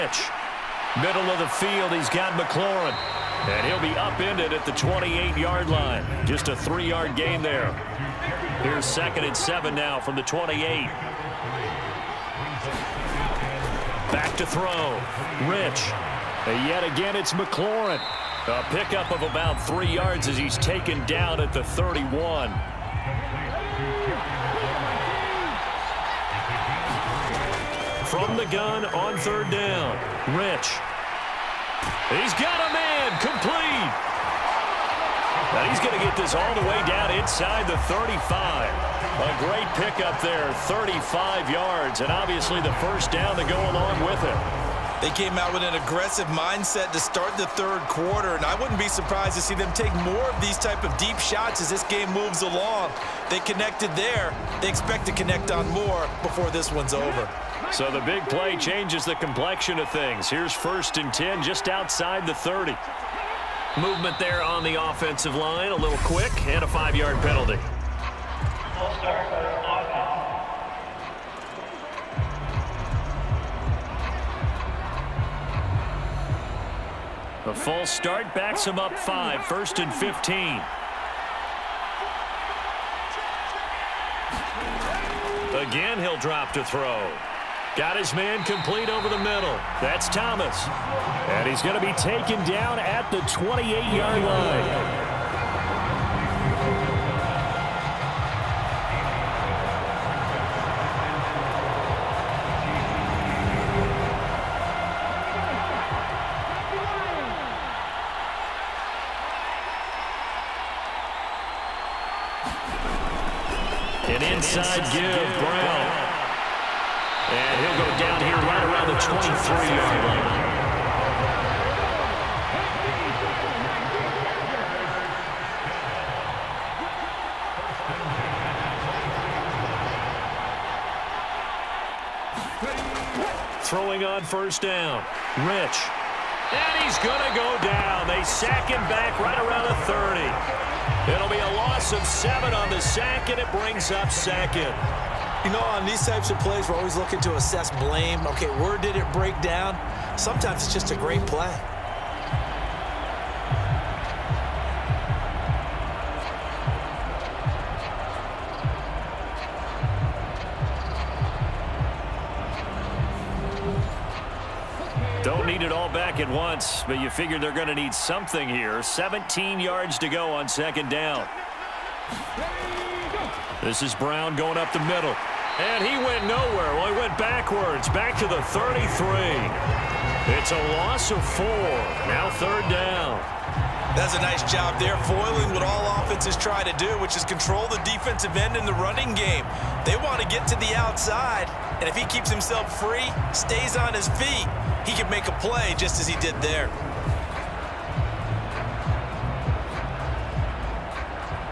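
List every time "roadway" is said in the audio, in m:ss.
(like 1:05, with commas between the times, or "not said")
not said.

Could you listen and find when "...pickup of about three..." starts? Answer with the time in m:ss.
0:18.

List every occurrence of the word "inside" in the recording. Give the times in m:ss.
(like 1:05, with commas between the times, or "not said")
0:37, 1:54.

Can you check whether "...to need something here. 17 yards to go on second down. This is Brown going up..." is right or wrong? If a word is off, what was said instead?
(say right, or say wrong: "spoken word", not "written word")
right.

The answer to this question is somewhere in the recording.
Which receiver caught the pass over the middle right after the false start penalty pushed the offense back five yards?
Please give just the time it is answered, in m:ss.
1:30.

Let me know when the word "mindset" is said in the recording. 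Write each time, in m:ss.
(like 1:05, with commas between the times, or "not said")
0:46.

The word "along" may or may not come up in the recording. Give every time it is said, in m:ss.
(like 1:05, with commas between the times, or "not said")
0:43, 0:52.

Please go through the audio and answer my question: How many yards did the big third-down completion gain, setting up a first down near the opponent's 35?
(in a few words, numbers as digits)
35 yards.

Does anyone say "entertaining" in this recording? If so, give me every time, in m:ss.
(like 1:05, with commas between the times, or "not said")
not said.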